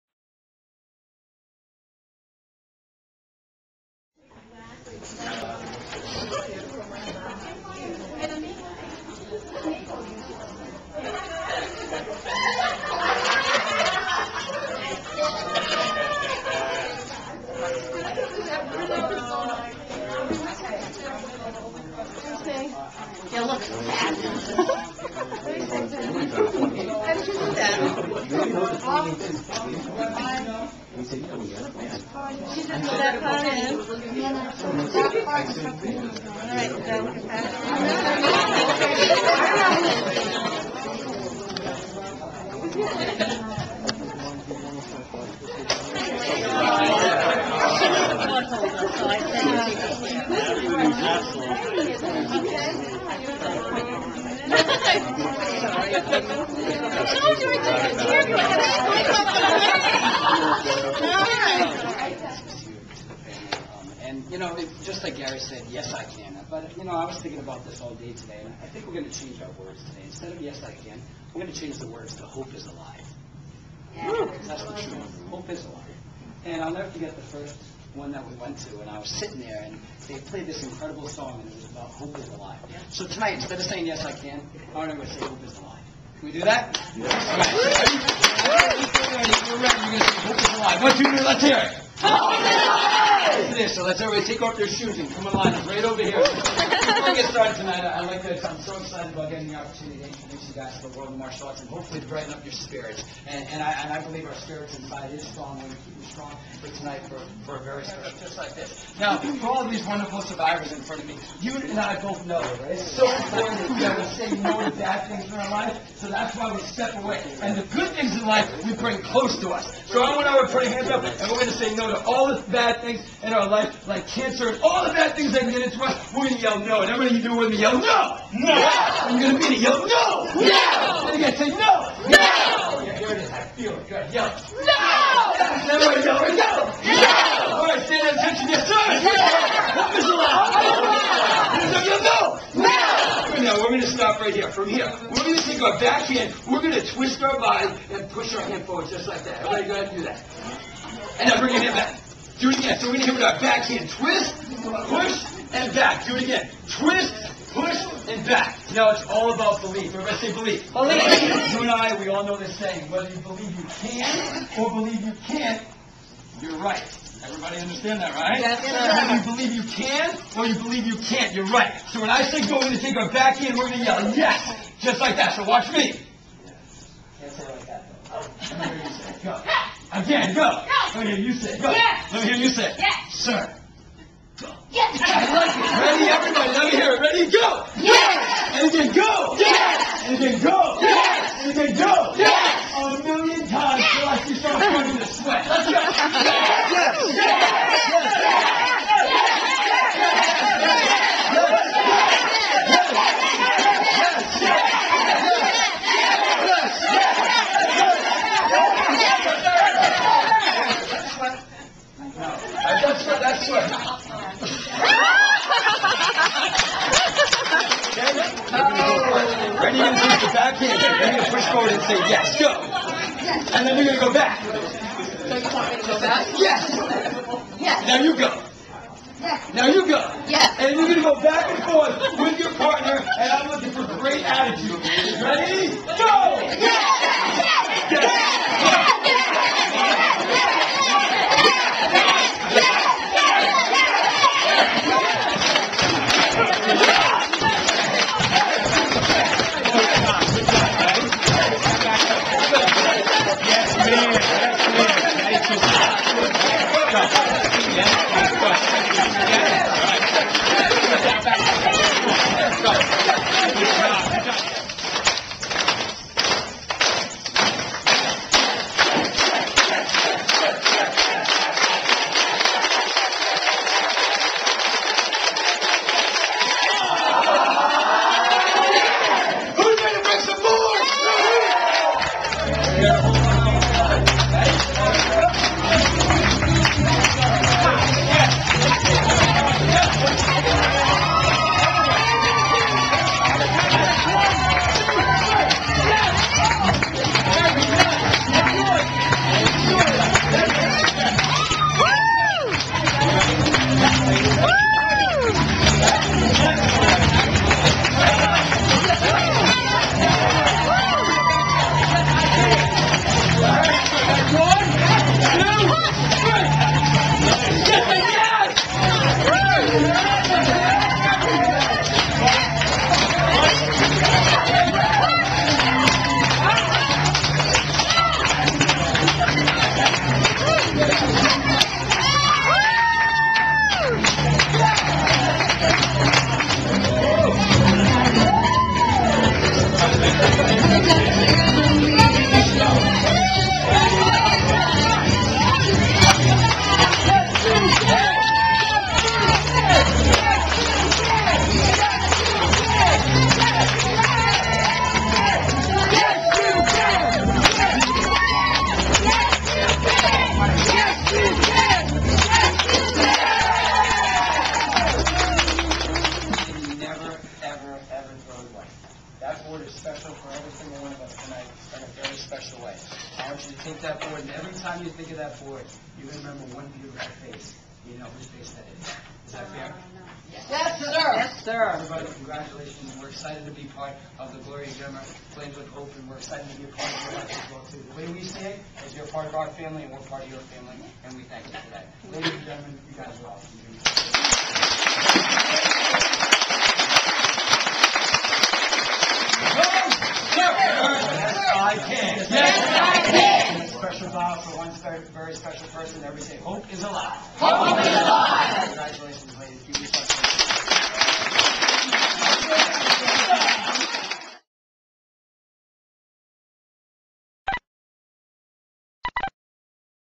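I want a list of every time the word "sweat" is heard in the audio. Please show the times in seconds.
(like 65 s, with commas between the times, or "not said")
195 s.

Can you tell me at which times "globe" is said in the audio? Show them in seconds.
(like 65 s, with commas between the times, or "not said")
not said.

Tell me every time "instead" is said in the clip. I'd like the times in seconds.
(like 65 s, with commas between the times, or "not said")
70 s, 83 s.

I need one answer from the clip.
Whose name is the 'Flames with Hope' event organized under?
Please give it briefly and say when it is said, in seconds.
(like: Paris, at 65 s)
Gloria Gemma, at 384 s.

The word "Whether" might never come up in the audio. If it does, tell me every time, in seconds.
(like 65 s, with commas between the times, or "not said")
162 s, 168 s.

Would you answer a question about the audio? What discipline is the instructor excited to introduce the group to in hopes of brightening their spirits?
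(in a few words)
Martial arts.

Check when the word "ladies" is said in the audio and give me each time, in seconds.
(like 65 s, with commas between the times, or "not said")
392 s, 409 s.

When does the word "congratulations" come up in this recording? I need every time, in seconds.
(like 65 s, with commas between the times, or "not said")
382 s, 408 s.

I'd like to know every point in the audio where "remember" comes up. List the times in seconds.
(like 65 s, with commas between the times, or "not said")
376 s.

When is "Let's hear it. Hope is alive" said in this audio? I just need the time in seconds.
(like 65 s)
91 s.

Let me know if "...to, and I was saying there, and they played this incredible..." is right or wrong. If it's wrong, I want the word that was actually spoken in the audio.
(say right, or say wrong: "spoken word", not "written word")
wrong: "sitting", not "saying".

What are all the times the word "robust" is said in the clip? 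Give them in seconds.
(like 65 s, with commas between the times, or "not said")
not said.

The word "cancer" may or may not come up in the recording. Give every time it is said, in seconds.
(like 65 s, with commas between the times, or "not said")
124 s.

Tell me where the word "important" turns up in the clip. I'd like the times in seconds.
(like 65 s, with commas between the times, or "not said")
113 s.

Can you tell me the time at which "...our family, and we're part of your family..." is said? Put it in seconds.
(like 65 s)
389 s.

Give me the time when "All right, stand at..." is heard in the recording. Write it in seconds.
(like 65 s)
137 s.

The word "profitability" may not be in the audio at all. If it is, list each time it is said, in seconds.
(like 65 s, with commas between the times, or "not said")
not said.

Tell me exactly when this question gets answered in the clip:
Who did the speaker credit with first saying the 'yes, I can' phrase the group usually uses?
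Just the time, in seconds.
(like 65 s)
65 s.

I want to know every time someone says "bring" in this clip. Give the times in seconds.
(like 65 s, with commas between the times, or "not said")
118 s, 151 s.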